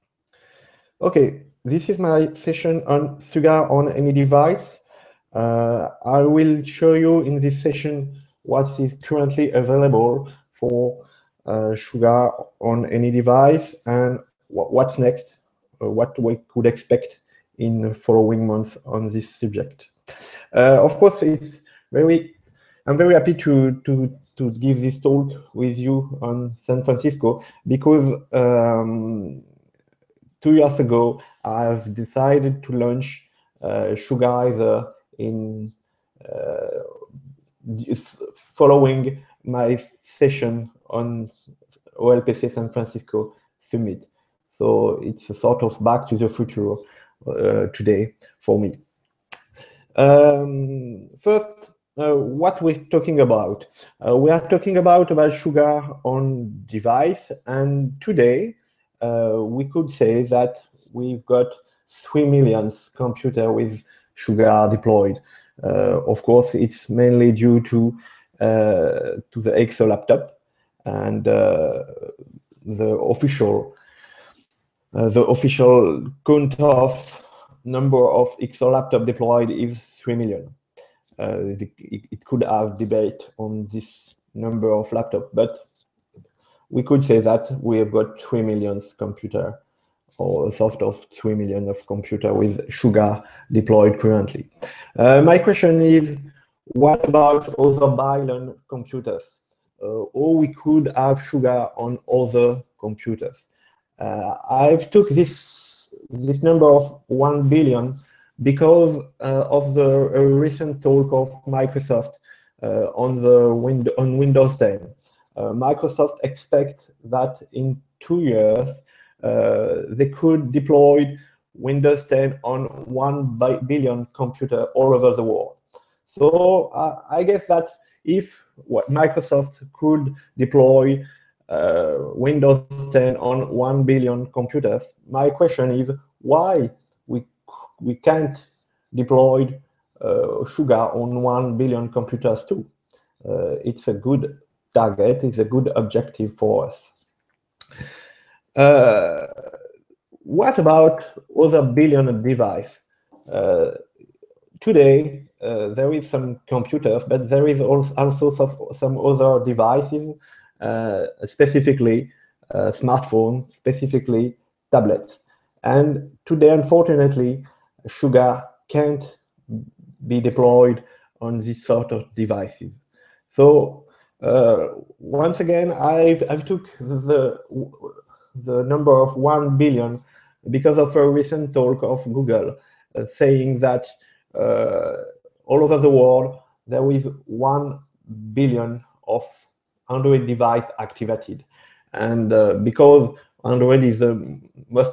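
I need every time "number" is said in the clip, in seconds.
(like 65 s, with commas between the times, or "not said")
77 s, 84 s, 106 s, 178 s.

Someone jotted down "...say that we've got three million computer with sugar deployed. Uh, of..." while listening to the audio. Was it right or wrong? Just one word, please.
right.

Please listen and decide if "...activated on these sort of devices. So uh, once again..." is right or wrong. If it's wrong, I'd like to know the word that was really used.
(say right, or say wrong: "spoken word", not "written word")
wrong: "deployed", not "activated".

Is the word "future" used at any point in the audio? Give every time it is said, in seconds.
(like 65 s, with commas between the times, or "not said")
46 s.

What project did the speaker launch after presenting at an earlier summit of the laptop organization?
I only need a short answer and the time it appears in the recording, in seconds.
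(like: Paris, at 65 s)
Sugarizer, at 33 s.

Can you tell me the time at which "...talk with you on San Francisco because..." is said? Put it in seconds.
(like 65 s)
24 s.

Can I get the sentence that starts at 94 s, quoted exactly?
Uh, my question is, what about other billion computers?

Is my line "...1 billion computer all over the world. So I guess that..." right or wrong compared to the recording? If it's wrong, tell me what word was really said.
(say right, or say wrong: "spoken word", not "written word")
right.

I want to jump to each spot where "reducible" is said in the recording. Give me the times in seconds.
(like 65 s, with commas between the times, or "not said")
not said.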